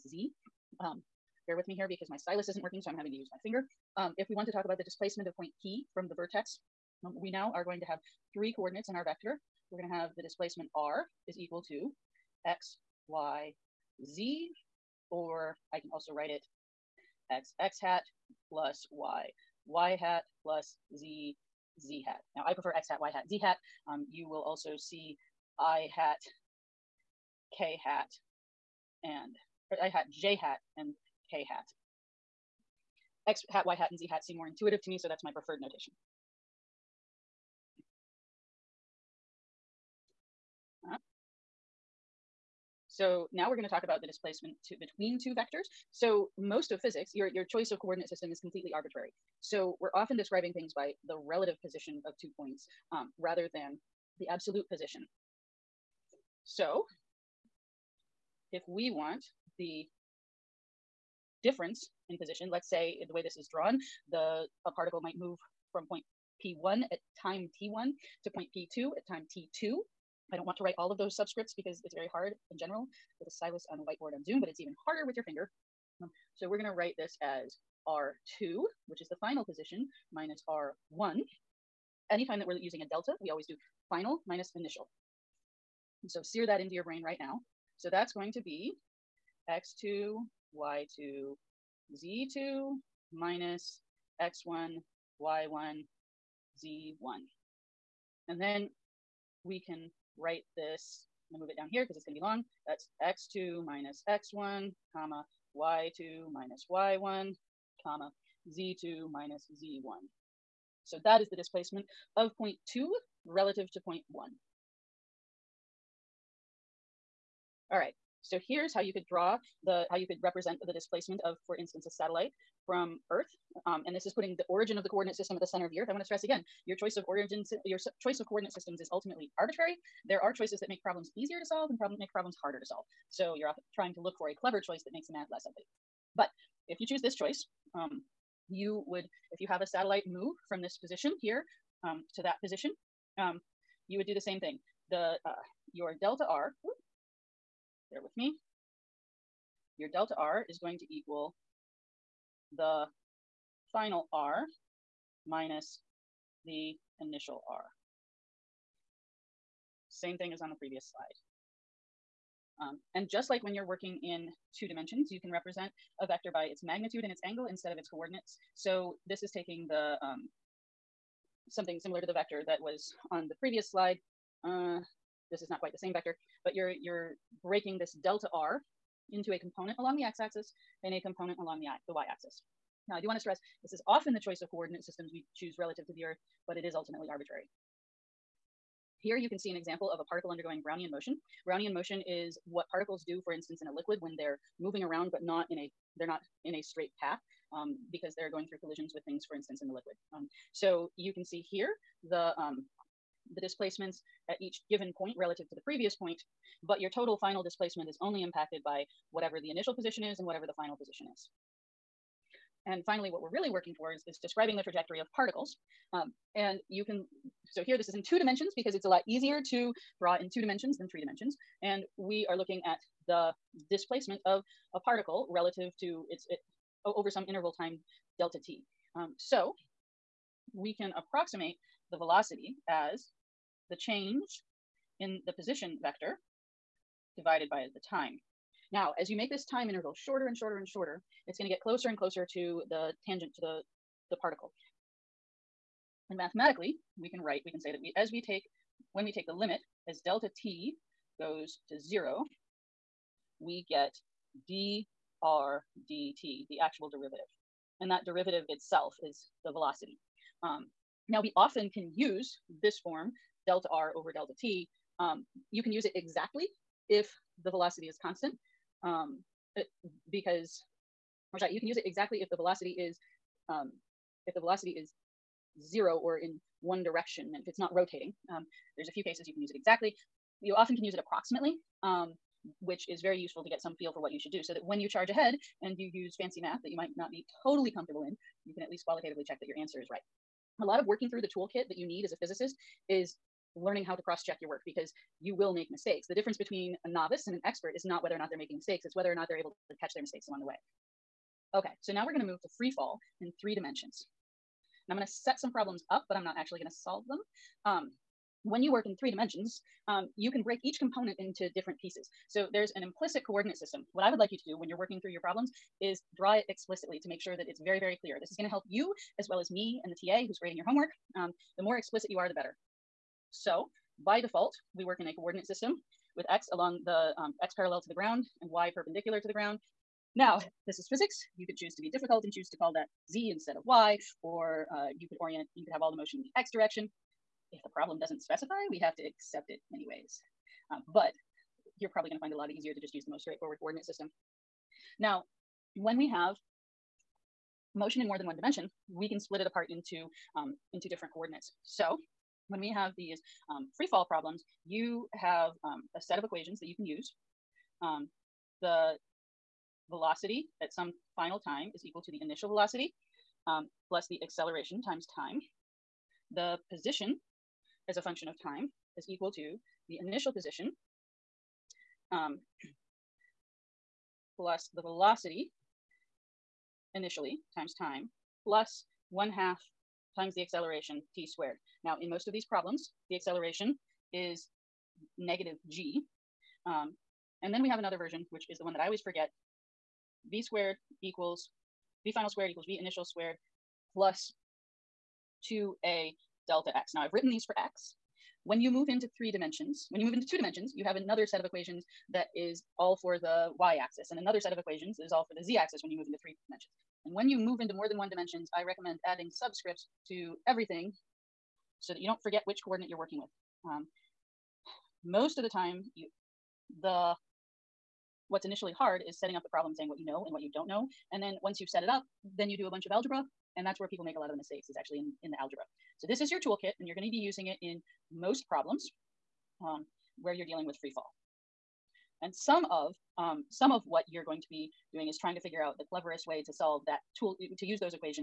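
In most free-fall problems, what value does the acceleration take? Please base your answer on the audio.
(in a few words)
Negative g.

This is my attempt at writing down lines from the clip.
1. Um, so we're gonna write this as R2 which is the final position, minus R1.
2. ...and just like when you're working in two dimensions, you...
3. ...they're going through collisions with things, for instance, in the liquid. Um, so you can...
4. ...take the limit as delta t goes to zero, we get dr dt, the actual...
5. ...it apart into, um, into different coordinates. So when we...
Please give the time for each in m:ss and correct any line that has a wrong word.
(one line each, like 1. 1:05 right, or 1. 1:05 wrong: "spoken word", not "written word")
1. 1:16 right
2. 2:42 right
3. 3:18 right
4. 4:09 right
5. 5:49 right.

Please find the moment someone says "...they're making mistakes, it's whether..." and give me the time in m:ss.
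4:58.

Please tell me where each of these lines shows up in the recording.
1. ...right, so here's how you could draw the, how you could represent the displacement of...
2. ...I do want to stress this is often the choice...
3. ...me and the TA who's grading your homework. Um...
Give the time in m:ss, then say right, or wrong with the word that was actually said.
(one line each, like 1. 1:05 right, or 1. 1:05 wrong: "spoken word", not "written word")
1. 1:57 right
2. 3:02 right
3. 5:19 right.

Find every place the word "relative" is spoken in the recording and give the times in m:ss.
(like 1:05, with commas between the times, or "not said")
0:51, 1:53, 3:05, 3:25, 3:45.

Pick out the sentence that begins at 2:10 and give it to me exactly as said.
There are choices that make problems easier to solve and problem make problems harder to solve.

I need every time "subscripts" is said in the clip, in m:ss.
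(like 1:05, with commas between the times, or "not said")
1:11, 6:49.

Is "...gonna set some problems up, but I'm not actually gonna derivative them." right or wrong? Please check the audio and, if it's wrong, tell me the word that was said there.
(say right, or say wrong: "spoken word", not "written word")
wrong: "solve", not "derivative".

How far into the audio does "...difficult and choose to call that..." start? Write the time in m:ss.
5:31.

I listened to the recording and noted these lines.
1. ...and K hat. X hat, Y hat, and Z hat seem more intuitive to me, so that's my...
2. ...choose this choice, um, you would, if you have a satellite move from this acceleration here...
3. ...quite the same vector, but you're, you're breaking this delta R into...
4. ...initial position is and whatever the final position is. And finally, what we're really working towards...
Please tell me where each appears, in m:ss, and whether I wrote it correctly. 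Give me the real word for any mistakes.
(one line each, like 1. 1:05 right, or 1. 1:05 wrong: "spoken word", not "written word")
1. 0:30 right
2. 2:16 wrong: "position", not "acceleration"
3. 2:55 right
4. 3:29 right.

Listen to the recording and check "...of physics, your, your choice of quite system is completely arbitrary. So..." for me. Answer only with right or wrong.
wrong.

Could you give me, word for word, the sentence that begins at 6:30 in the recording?
v squared equals v final squared equals v initial squared plus 2a delta x.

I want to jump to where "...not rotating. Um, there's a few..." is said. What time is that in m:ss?
4:37.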